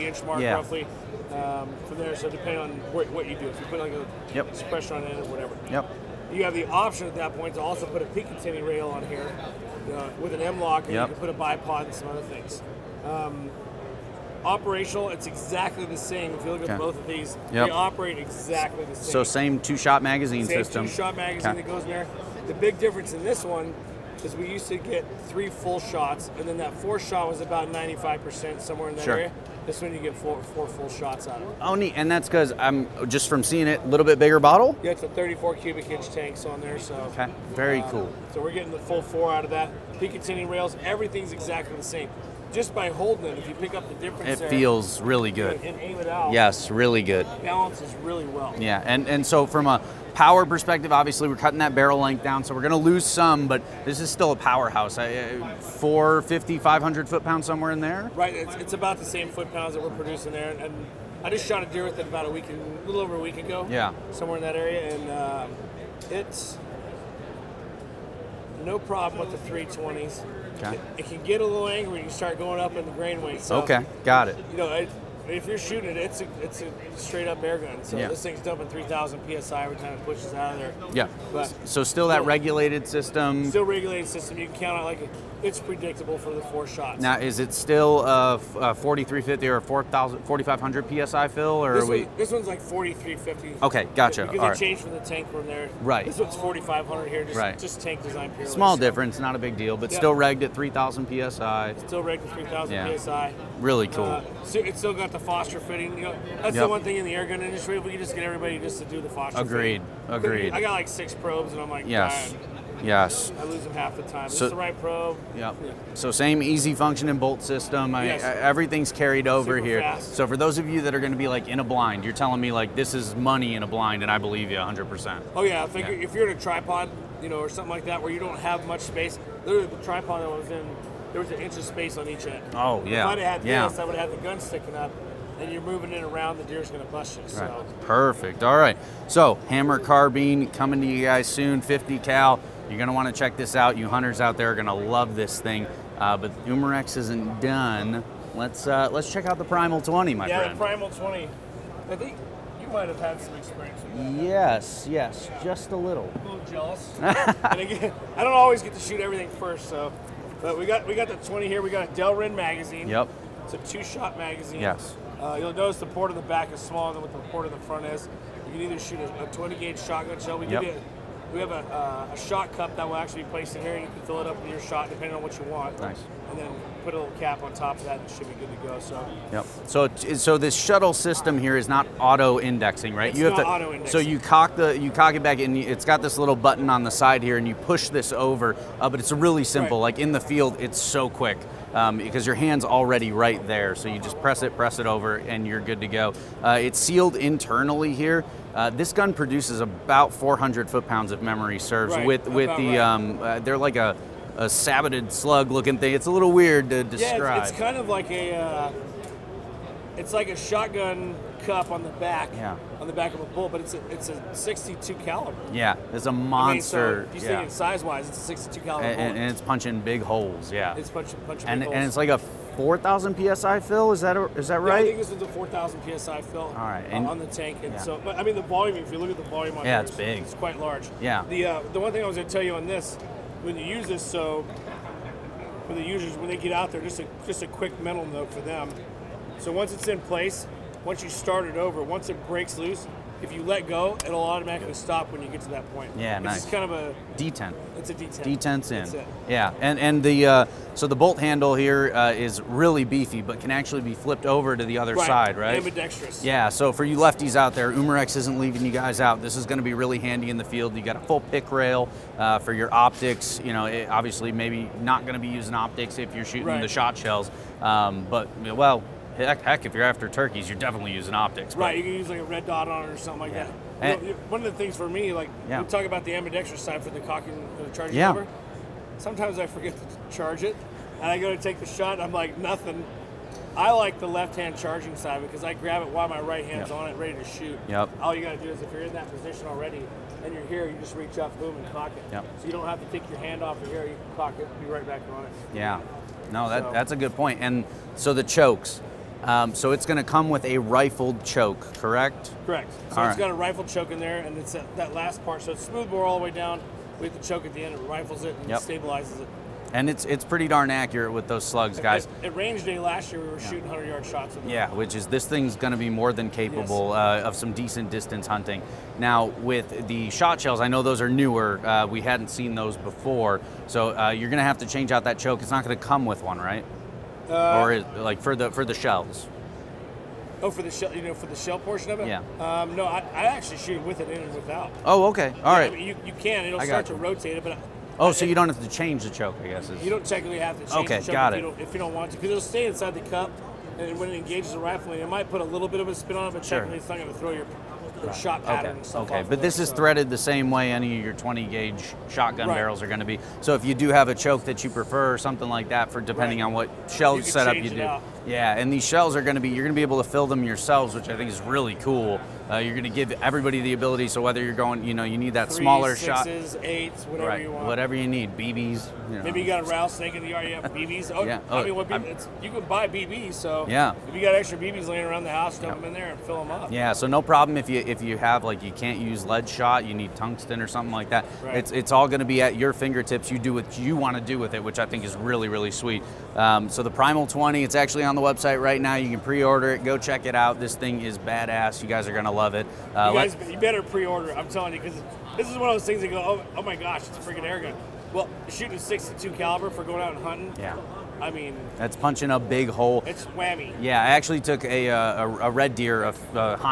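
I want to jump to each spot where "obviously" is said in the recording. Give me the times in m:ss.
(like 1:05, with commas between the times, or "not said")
0:50, 4:23.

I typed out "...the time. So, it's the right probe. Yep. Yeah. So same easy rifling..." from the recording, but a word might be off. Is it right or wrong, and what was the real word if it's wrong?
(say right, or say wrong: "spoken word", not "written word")
wrong: "functioning", not "rifling".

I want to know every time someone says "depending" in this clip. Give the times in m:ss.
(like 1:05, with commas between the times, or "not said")
0:02, 2:54, 5:56.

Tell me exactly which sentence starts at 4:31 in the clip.
Right, you can use like a red dot on it or something like yeah.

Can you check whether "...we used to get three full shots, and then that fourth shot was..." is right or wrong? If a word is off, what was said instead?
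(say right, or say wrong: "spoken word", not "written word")
right.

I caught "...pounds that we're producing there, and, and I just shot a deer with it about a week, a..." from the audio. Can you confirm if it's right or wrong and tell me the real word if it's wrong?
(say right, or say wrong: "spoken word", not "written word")
right.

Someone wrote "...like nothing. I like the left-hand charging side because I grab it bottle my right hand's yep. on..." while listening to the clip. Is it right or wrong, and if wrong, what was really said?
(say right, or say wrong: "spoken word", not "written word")
wrong: "while", not "bottle".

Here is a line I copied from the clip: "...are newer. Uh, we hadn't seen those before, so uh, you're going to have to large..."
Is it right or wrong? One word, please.
wrong.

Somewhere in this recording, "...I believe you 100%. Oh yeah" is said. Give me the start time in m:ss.
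2:04.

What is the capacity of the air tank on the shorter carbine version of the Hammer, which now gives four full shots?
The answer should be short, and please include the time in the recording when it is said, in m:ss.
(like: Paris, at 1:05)
34 cubic inch, at 0:35.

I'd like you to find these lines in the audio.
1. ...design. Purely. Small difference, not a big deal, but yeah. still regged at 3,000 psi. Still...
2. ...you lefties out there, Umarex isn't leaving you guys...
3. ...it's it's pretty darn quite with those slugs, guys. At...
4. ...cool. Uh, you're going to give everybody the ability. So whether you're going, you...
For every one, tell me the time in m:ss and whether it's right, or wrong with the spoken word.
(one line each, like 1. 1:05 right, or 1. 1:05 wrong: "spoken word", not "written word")
1. 1:38 right
2. 4:16 right
3. 5:09 wrong: "accurate", not "quite"
4. 6:01 right.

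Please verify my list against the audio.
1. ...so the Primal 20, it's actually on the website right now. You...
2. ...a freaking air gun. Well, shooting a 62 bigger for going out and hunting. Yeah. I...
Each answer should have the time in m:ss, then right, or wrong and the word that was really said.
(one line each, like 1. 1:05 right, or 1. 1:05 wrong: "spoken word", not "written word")
1. 6:26 right
2. 6:37 wrong: "caliber", not "bigger".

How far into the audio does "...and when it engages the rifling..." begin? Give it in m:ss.
5:43.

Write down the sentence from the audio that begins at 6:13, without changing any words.
So yeah, if you got extra BBs laying around the house, dump yeah.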